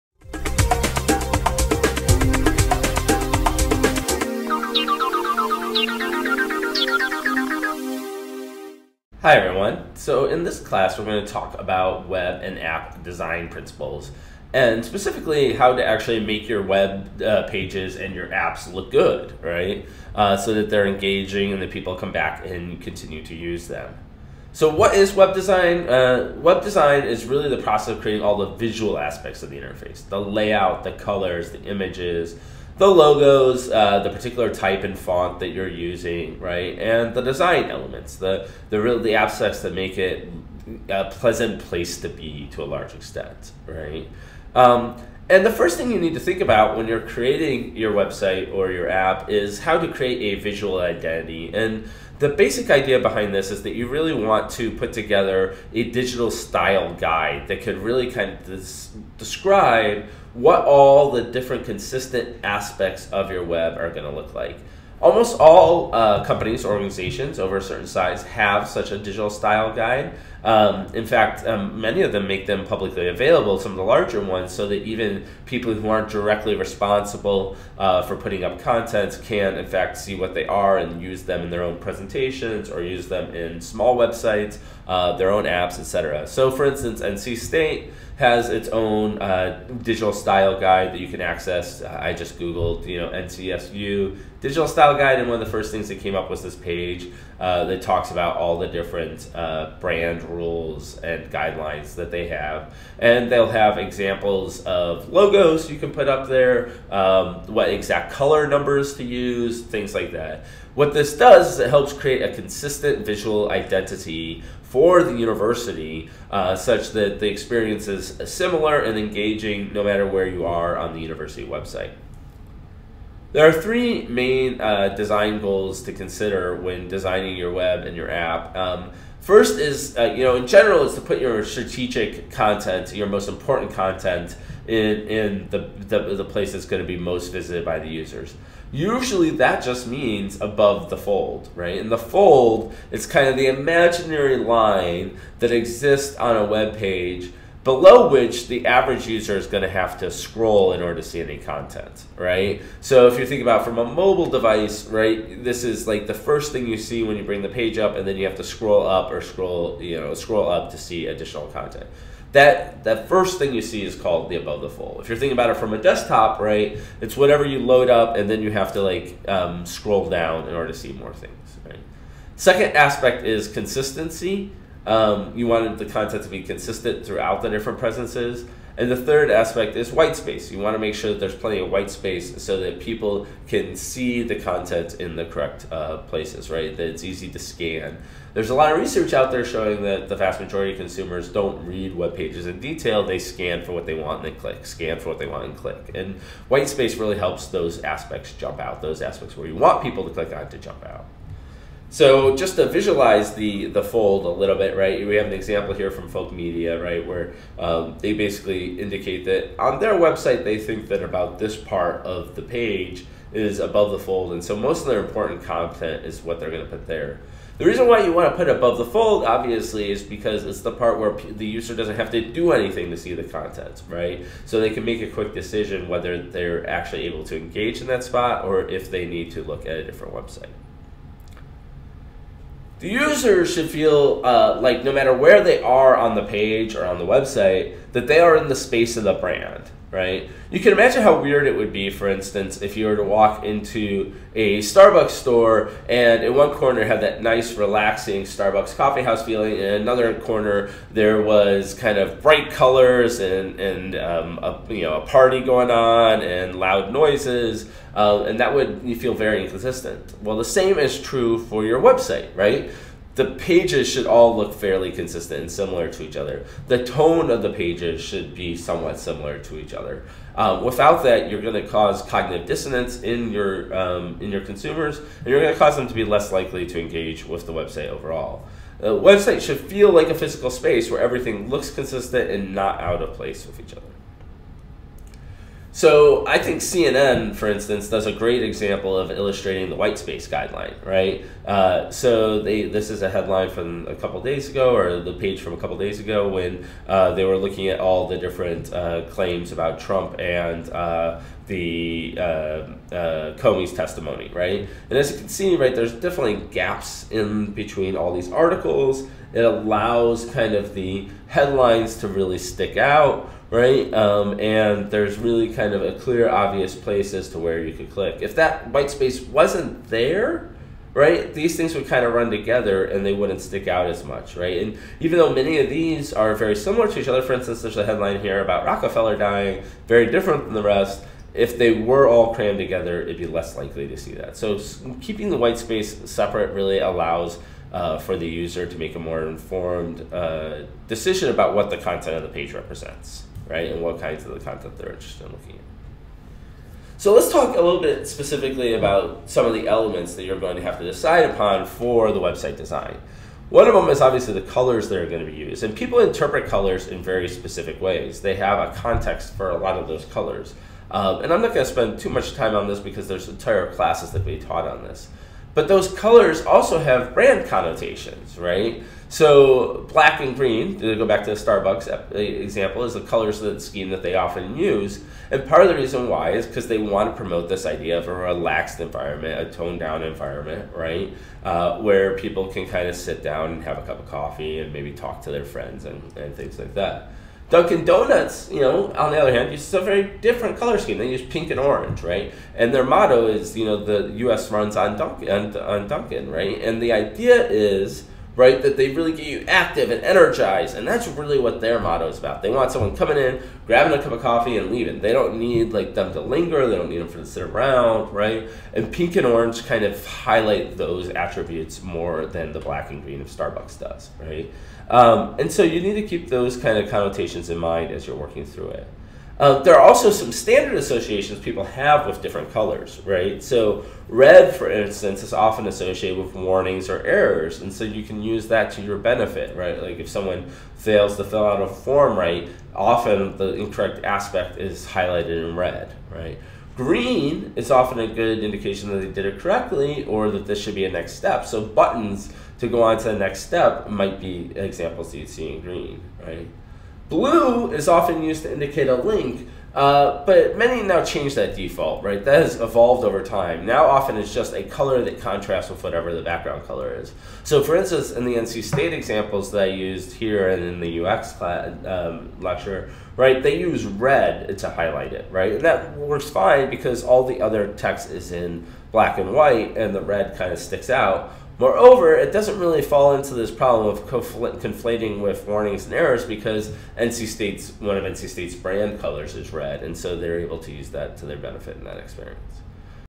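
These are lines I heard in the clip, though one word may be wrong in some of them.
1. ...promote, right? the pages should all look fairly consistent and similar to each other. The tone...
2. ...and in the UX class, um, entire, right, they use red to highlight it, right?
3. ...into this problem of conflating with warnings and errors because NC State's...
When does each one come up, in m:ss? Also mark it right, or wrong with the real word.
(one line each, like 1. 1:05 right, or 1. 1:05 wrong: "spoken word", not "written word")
1. 4:21 wrong: "website", not "promote"
2. 7:40 wrong: "lecture", not "entire"
3. 7:53 right.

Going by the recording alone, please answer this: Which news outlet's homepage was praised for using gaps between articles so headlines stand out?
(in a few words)
CNN.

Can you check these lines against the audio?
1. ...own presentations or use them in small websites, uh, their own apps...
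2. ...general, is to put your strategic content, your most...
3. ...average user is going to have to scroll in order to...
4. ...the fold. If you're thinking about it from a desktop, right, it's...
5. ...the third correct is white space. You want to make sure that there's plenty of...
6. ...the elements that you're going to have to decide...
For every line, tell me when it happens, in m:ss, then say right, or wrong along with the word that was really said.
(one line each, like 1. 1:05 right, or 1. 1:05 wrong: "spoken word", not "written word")
1. 1:21 right
2. 2:10 right
3. 2:28 right
4. 2:44 right
5. 2:58 wrong: "aspect", not "correct"
6. 5:49 right.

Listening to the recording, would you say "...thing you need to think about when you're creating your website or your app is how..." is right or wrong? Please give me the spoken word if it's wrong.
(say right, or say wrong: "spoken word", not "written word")
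right.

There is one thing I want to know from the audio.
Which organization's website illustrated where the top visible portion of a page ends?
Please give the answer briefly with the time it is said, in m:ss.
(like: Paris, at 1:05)
Folk Media, at 3:26.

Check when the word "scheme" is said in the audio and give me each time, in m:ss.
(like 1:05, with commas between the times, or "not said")
6:13, 6:30.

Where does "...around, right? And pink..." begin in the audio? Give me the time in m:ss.
6:47.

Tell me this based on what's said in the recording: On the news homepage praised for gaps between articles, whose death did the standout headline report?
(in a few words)
Rockefeller.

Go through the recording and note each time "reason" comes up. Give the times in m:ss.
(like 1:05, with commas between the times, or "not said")
3:37, 6:15.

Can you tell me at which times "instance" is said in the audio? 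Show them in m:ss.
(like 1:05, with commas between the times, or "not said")
1:26, 4:02, 4:47, 5:27, 7:04, 7:37.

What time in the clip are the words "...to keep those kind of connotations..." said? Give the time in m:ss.
6:56.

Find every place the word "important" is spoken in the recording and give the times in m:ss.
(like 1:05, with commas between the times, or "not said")
2:13, 3:35.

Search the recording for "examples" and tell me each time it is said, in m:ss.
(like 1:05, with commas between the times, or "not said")
1:43, 3:25, 4:48, 6:12, 7:24, 7:38.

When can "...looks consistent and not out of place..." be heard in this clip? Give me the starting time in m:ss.
4:41.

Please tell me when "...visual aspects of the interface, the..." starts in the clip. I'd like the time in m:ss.
0:28.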